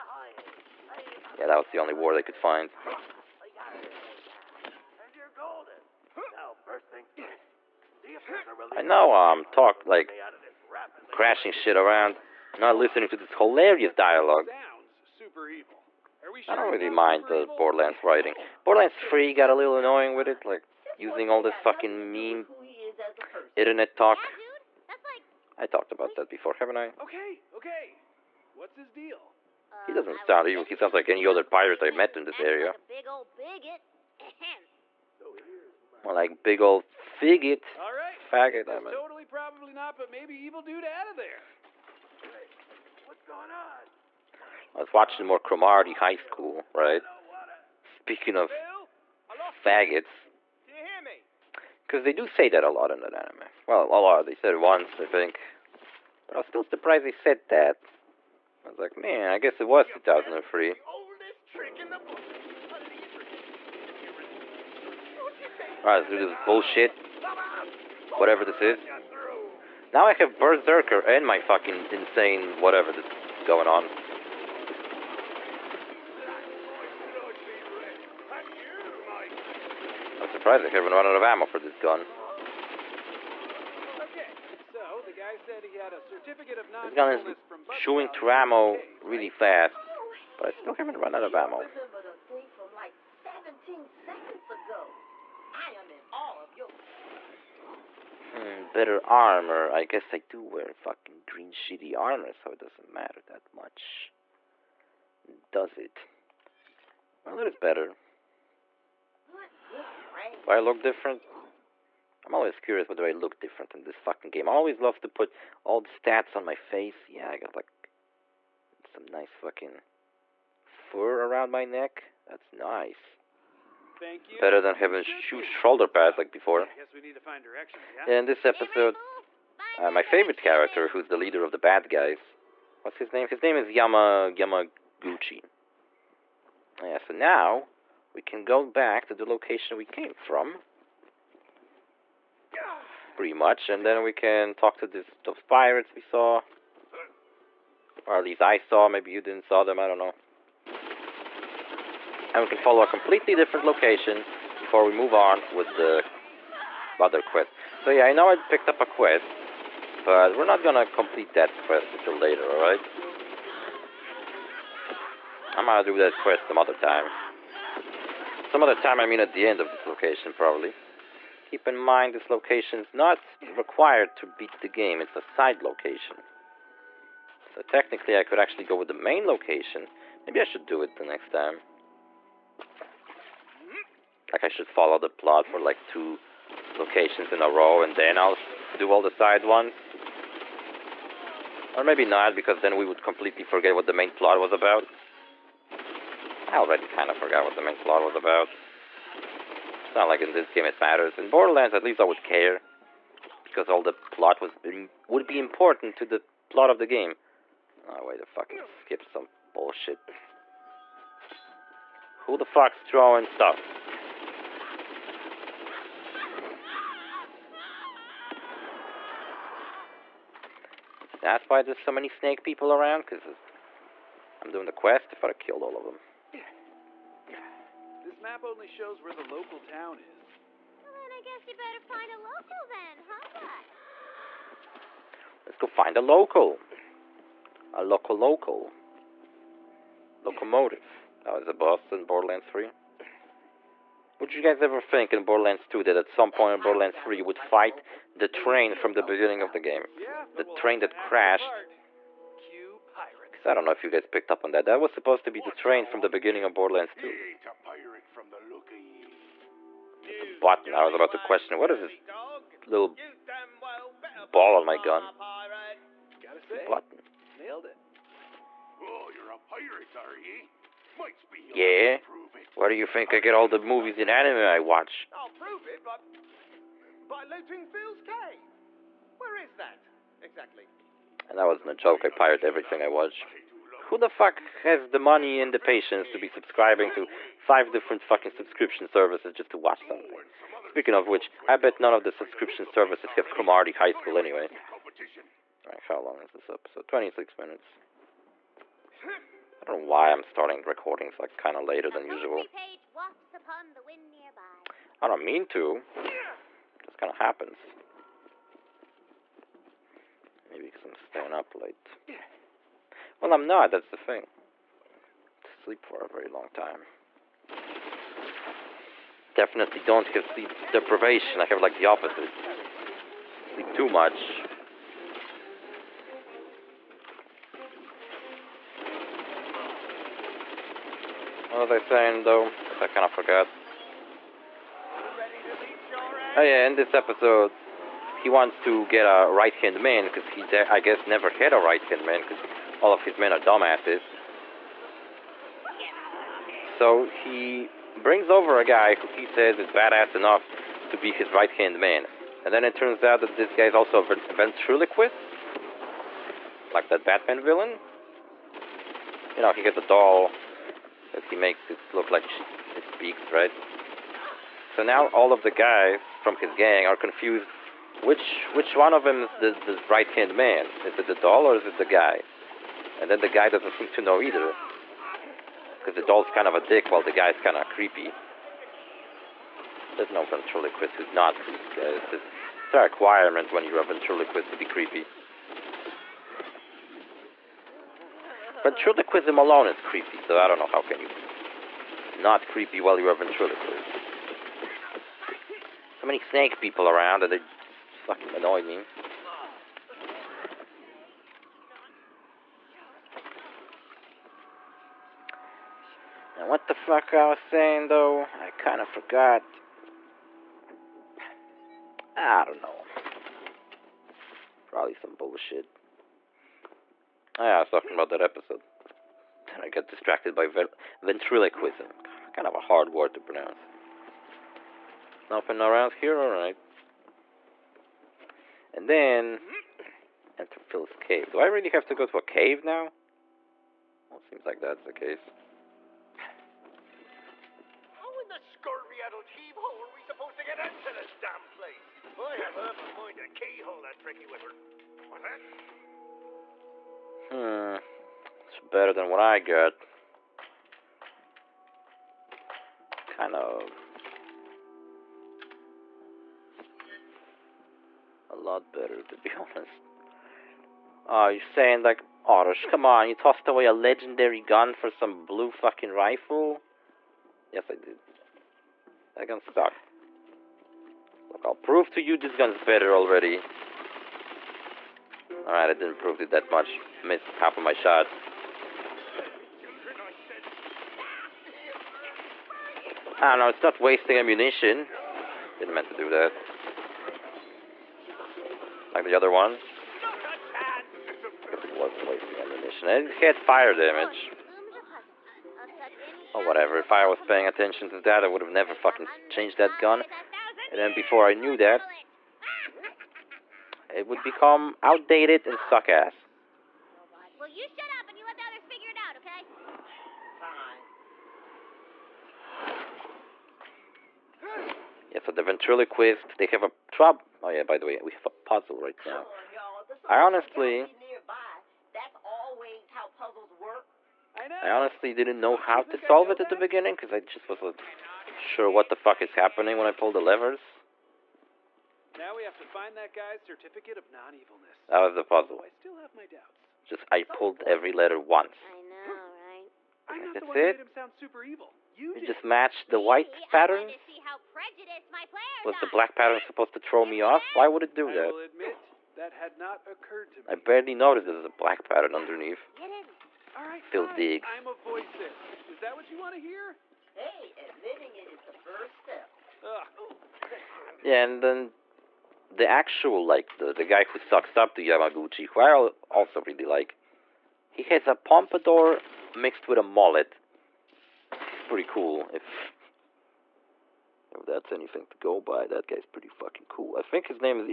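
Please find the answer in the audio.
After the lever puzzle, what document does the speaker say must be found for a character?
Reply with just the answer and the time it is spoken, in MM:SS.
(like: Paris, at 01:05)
Certificate of non-evilness, at 08:53.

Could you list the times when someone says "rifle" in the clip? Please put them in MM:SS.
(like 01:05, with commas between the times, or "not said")
07:45.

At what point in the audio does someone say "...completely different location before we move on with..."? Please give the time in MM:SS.
02:32.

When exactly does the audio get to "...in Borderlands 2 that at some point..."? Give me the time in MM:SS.
04:05.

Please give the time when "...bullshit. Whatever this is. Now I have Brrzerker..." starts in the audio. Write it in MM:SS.
01:06.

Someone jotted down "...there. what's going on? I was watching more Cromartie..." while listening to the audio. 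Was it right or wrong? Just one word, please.
right.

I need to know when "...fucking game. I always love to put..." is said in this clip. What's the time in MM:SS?
01:53.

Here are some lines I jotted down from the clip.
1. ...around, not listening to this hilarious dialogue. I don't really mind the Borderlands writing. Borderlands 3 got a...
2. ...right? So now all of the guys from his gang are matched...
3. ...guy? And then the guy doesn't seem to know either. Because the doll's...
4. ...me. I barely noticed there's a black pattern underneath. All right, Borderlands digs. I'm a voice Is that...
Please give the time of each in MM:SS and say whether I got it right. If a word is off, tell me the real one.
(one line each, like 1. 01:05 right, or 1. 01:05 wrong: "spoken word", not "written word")
1. 00:11 right
2. 06:03 wrong: "confused", not "matched"
3. 06:11 right
4. 09:10 wrong: "Phil", not "Borderlands".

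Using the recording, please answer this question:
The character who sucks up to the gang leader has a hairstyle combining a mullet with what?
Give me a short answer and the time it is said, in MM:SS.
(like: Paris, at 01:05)
Pompadour, at 09:28.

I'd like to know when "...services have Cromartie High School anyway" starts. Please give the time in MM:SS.
04:52.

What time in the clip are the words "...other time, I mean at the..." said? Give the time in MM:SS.
02:48.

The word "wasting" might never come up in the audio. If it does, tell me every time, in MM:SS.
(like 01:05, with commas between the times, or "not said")
08:03, 08:12.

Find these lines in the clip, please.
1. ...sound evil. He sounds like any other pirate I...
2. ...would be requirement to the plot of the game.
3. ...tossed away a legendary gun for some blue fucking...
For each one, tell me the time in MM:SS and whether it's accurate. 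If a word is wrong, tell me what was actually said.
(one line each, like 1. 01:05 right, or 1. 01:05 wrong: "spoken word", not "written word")
1. 00:30 right
2. 03:25 wrong: "important", not "requirement"
3. 07:43 right.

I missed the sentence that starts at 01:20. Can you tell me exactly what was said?
I'm surprised I haven't run out of ammo for this gun.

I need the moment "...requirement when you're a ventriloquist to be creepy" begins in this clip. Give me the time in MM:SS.
06:22.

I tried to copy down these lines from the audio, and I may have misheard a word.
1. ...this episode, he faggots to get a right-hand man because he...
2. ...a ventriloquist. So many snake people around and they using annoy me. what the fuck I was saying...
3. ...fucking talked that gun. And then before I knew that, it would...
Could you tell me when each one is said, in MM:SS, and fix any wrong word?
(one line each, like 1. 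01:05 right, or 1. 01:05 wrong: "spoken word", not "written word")
1. 05:36 wrong: "wants", not "faggots"
2. 06:33 wrong: "fucking", not "using"
3. 08:18 wrong: "changed", not "talked".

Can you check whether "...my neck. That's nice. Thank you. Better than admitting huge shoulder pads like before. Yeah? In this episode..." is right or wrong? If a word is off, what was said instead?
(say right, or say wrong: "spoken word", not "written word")
wrong: "having", not "admitting".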